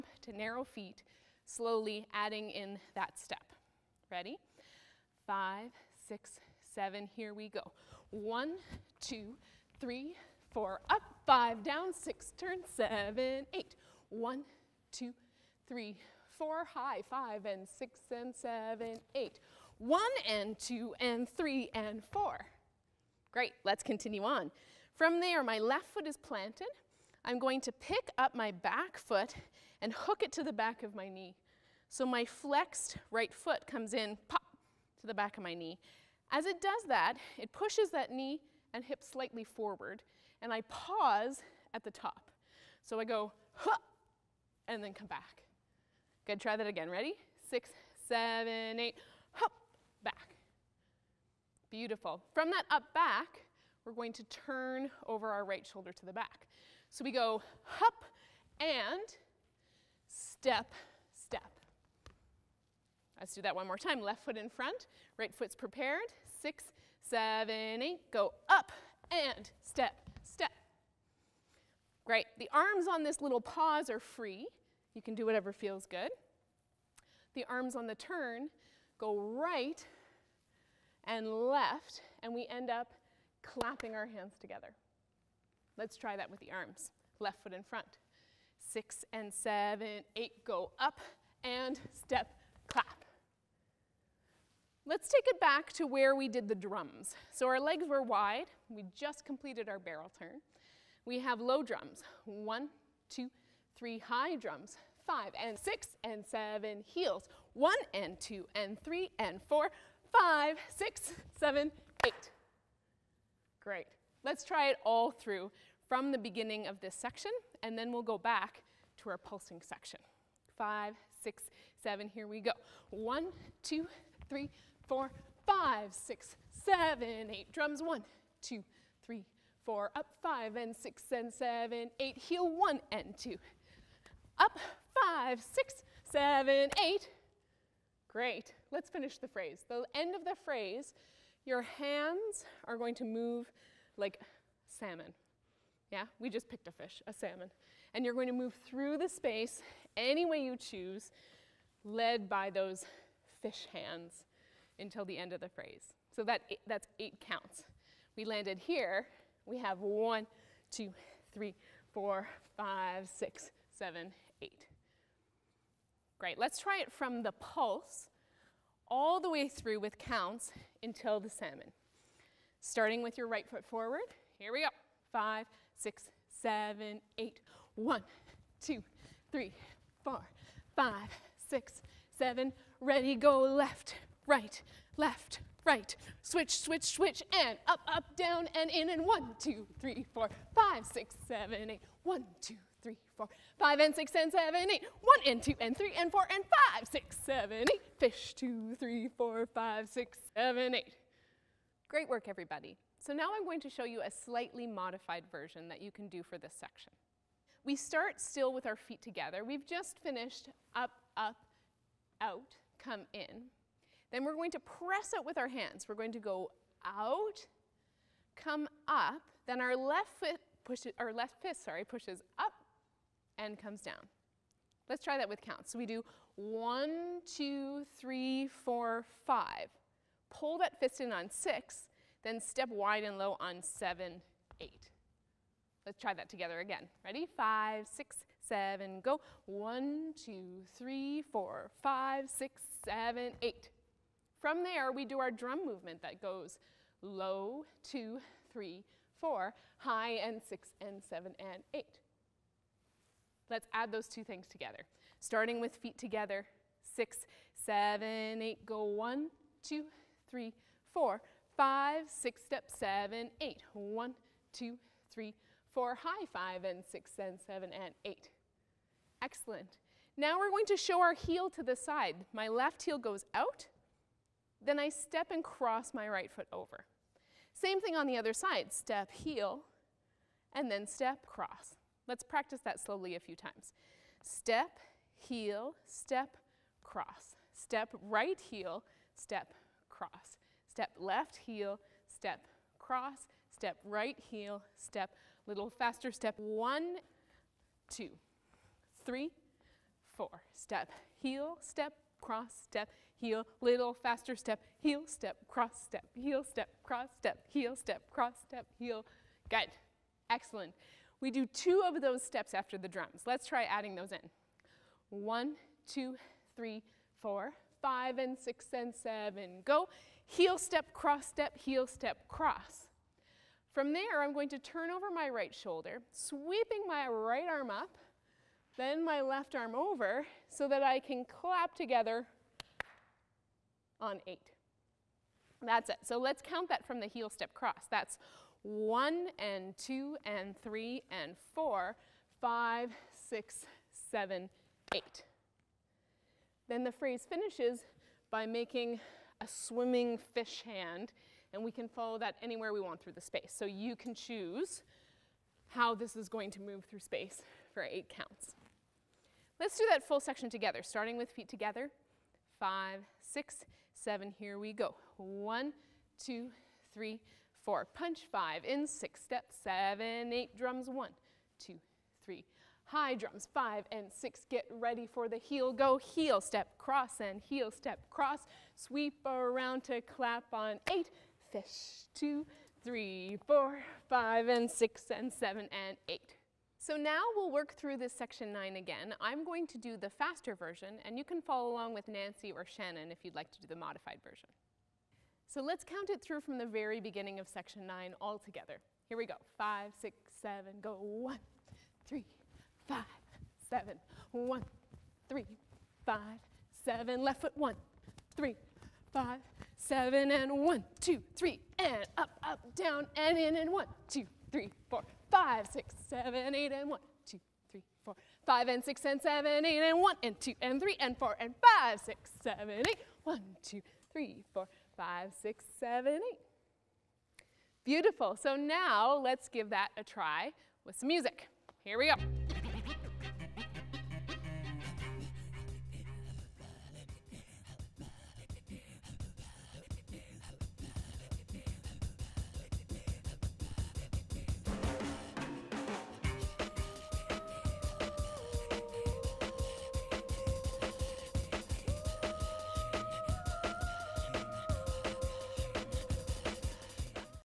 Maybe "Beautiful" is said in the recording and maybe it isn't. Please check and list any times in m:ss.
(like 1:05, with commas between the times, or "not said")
0:51, 7:07.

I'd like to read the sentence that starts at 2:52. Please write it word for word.
Starting with your right foot forward.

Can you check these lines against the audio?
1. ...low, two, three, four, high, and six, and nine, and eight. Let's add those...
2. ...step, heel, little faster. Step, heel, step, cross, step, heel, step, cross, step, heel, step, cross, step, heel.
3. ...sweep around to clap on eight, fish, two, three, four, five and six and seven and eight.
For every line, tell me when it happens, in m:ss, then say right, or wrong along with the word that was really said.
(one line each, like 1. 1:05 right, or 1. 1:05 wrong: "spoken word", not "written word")
1. 4:07 wrong: "seven", not "nine"
2. 5:02 right
3. 6:18 right.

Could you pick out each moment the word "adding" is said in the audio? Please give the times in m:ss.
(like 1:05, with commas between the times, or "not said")
0:02, 5:13.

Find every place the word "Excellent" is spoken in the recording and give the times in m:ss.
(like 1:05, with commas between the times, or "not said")
4:29, 5:10.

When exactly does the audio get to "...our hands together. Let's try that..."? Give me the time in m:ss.
1:23.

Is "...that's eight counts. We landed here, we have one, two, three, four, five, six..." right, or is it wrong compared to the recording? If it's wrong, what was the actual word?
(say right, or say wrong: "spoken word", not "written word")
right.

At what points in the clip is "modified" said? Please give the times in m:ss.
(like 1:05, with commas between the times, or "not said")
3:24, 6:33.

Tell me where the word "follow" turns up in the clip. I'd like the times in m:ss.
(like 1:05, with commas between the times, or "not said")
5:51, 6:31.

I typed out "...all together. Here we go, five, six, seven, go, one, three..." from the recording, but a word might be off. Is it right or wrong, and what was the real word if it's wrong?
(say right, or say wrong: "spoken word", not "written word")
right.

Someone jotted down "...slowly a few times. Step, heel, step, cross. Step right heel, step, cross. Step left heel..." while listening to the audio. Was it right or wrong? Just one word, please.
right.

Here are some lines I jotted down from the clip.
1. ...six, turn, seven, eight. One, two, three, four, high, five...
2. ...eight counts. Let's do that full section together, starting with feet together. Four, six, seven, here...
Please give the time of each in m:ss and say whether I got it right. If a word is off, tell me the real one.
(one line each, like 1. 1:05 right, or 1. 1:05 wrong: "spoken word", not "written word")
1. 0:11 right
2. 5:57 wrong: "Five", not "Four".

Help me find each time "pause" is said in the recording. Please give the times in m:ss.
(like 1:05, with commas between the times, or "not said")
0:40, 1:13.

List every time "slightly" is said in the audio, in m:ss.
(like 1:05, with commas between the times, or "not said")
0:39, 3:24.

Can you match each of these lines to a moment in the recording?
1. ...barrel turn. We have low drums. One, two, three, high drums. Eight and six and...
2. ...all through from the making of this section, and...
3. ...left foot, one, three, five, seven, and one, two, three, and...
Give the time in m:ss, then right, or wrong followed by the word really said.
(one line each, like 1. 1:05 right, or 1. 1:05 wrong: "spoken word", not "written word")
1. 1:39 wrong: "Five", not "Eight"
2. 1:54 wrong: "beginning", not "making"
3. 6:47 right.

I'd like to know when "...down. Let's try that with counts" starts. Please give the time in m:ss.
3:43.